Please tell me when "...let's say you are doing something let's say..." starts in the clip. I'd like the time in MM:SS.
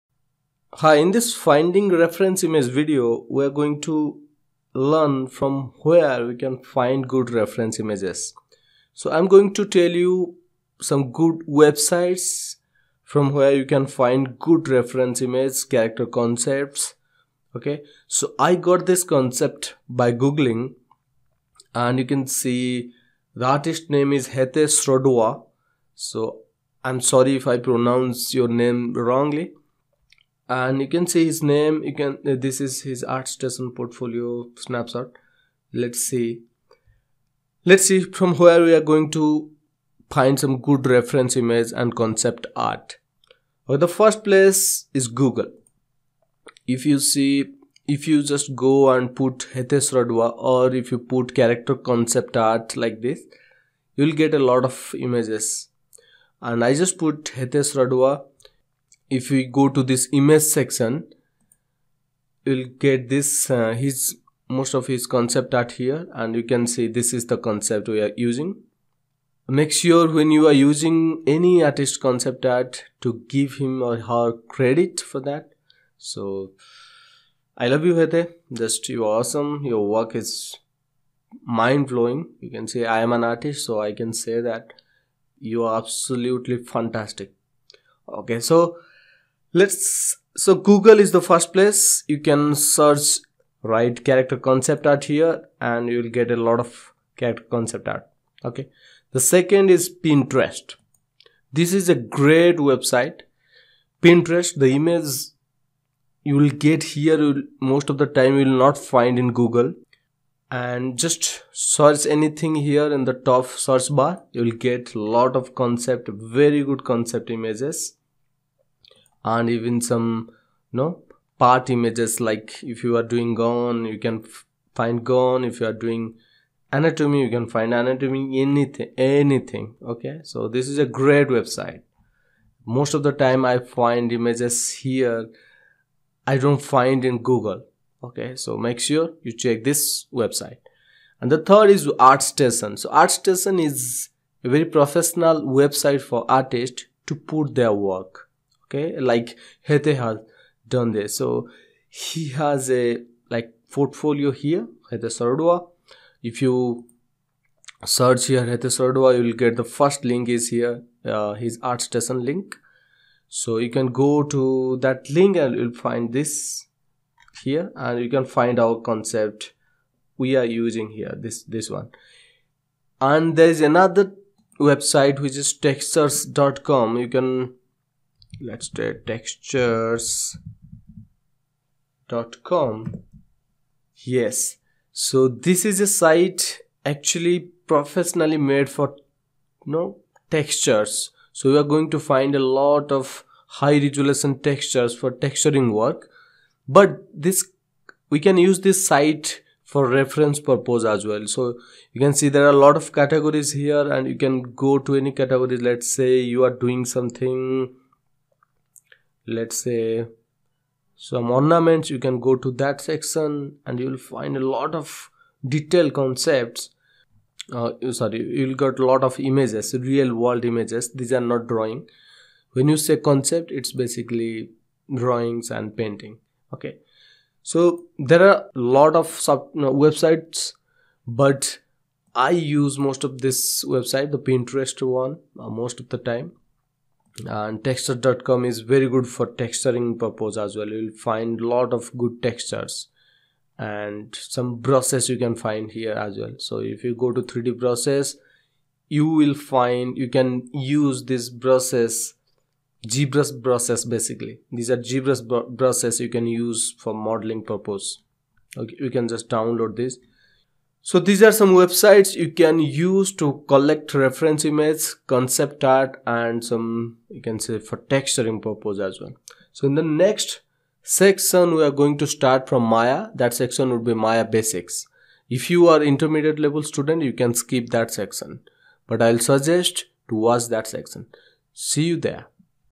03:25.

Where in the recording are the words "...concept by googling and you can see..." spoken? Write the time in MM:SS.
00:19.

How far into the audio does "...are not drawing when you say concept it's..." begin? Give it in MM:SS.
03:41.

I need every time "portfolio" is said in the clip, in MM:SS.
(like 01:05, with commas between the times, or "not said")
00:33, 02:33.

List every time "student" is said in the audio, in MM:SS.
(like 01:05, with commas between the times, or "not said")
04:36.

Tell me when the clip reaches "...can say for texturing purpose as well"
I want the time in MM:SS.
04:27.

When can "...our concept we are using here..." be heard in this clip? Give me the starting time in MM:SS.
02:48.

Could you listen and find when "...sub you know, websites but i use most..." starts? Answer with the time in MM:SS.
03:49.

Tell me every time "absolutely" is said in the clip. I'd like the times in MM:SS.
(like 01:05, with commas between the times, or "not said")
01:25.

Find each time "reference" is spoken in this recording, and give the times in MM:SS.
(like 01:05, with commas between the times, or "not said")
00:01, 00:07, 00:14, 00:40, 03:19, 04:23.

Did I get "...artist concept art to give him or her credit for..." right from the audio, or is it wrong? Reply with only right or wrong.
right.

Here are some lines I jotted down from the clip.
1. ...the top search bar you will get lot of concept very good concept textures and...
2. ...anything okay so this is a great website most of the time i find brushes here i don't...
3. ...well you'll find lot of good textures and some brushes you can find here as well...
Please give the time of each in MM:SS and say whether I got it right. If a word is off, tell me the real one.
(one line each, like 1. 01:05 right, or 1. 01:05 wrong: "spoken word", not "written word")
1. 01:53 wrong: "images", not "textures"
2. 02:08 wrong: "images", not "brushes"
3. 04:00 right.